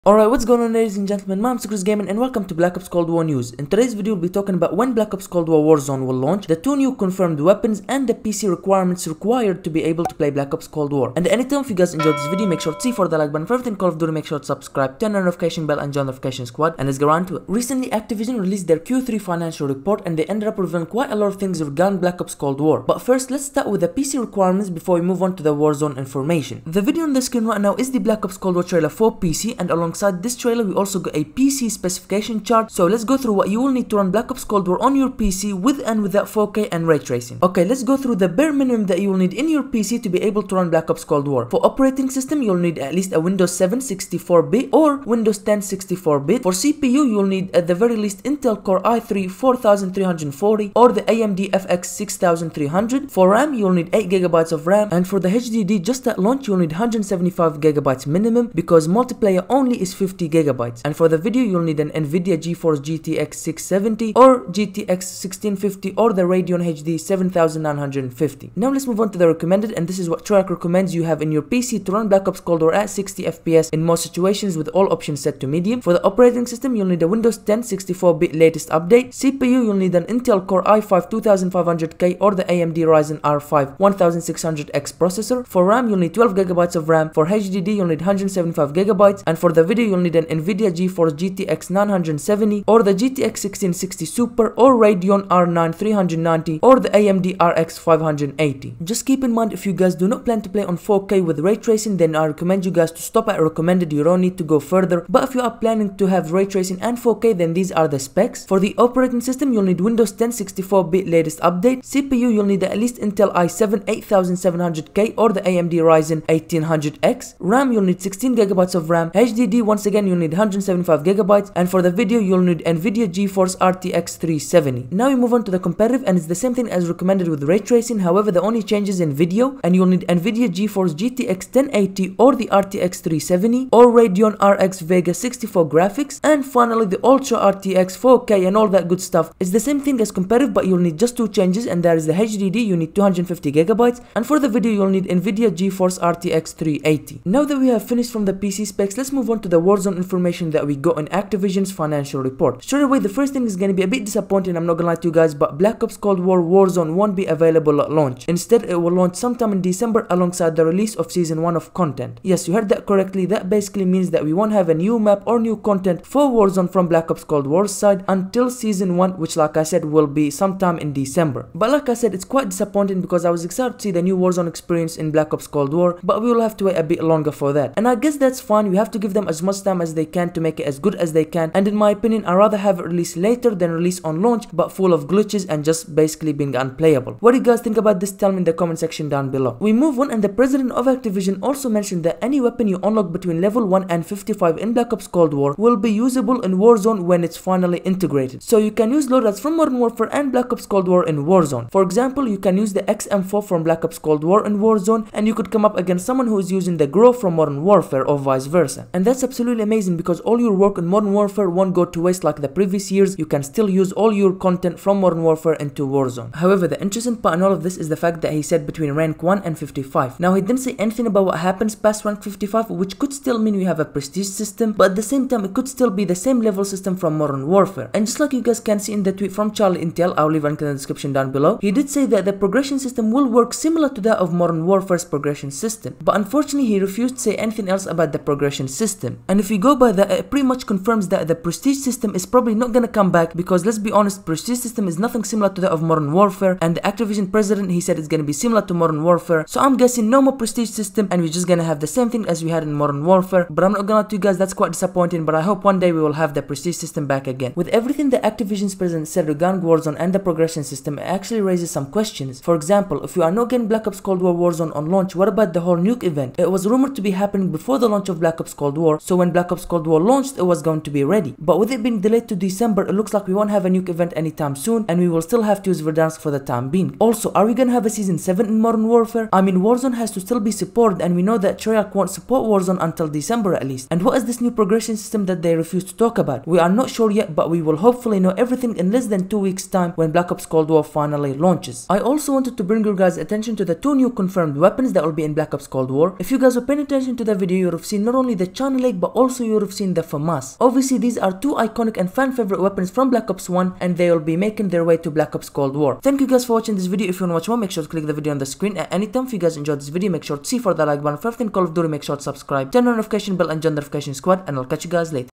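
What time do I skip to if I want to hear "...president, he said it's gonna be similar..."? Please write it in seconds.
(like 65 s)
247 s.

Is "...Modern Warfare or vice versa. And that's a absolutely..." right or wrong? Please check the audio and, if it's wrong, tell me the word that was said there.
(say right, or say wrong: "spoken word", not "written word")
right.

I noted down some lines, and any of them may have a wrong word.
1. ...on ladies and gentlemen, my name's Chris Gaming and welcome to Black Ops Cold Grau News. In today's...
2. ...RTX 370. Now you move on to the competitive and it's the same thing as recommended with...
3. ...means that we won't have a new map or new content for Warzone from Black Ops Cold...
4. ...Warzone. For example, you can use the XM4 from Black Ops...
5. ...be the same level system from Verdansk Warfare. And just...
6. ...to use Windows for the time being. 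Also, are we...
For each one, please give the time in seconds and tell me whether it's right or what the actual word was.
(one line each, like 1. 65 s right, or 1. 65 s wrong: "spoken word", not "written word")
1. 0 s wrong: "War", not "Grau"
2. 123 s right
3. 163 s right
4. 201 s right
5. 225 s wrong: "Modern", not "Verdansk"
6. 275 s wrong: "Verdansk", not "Windows".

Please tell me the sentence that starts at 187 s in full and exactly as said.
What do you guys think about this?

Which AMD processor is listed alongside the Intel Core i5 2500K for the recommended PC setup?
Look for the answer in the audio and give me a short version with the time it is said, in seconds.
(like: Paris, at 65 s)
AMD Ryzen R5 1600X, at 82 s.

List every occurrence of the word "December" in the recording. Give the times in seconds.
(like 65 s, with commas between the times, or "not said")
159 s, 170 s, 272 s, 283 s.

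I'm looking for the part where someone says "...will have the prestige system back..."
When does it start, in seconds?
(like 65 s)
256 s.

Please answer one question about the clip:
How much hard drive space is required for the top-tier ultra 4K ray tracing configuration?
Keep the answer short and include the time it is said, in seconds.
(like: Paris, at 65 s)
250 gigabytes, at 142 s.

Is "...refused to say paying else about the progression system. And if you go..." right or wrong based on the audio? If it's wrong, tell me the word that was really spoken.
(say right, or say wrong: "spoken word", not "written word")
wrong: "anything", not "paying".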